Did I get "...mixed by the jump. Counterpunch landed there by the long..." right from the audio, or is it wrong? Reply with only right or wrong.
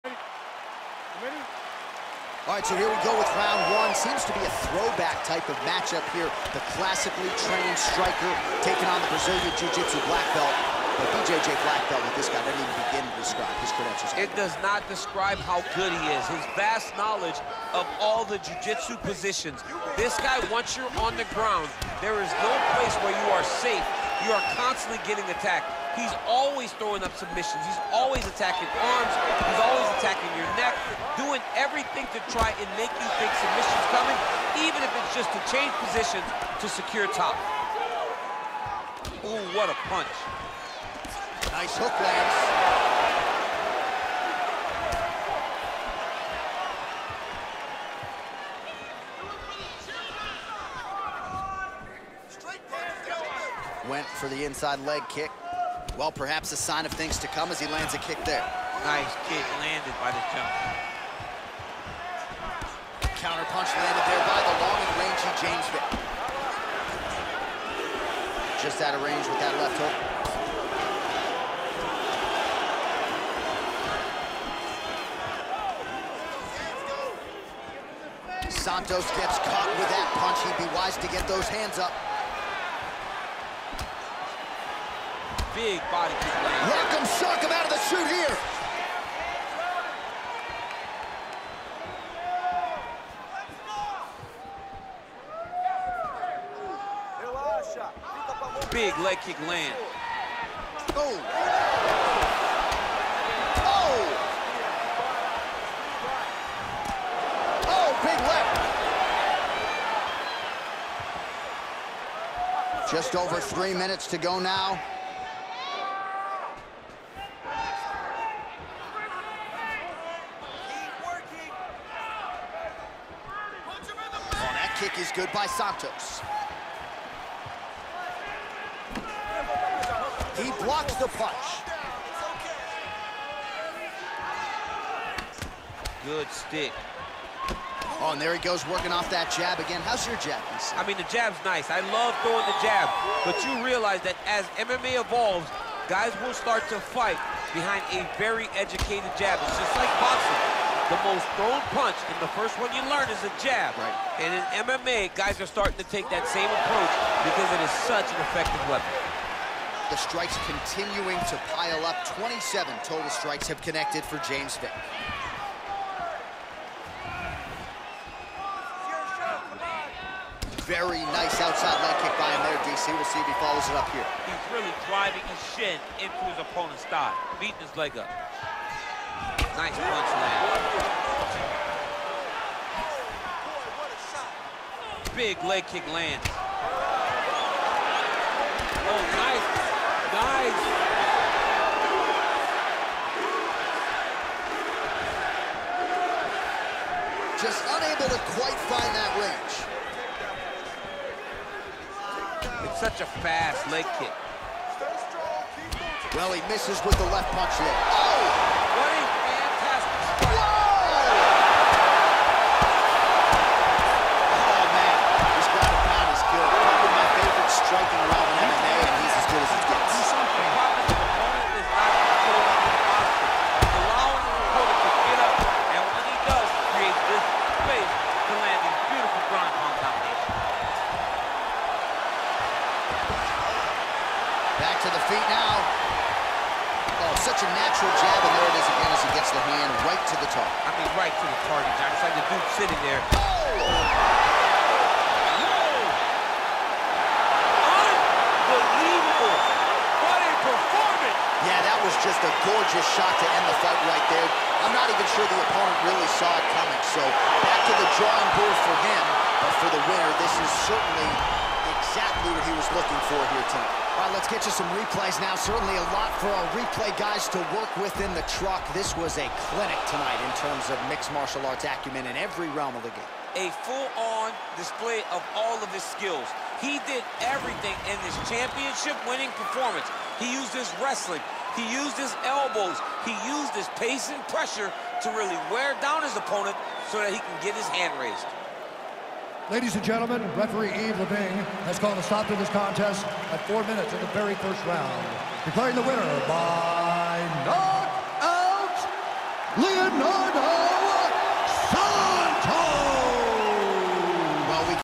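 wrong.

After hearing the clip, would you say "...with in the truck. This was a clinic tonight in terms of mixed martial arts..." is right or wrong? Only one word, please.
right.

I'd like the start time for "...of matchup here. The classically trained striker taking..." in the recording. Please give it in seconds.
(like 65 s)
5 s.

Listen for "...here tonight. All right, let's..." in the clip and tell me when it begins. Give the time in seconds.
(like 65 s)
263 s.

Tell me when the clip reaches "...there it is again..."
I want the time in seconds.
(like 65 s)
238 s.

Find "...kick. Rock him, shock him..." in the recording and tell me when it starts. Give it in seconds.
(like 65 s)
86 s.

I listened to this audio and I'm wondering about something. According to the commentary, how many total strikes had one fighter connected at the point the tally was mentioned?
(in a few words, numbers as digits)
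27.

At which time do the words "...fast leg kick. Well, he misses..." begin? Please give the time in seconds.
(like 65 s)
203 s.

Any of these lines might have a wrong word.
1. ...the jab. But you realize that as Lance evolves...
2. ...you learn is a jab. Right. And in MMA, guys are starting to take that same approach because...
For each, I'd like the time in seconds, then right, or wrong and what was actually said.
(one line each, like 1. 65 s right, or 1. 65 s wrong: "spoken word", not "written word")
1. 142 s wrong: "MMA", not "Lance"
2. 152 s right.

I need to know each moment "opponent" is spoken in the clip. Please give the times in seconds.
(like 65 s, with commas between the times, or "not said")
176 s, 255 s, 286 s.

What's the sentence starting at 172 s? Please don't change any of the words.
We'll see if he follows it up here.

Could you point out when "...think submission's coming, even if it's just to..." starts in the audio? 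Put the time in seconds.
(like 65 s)
33 s.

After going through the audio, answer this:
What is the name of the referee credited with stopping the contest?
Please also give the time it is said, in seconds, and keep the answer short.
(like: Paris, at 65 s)
Eve Leving, at 290 s.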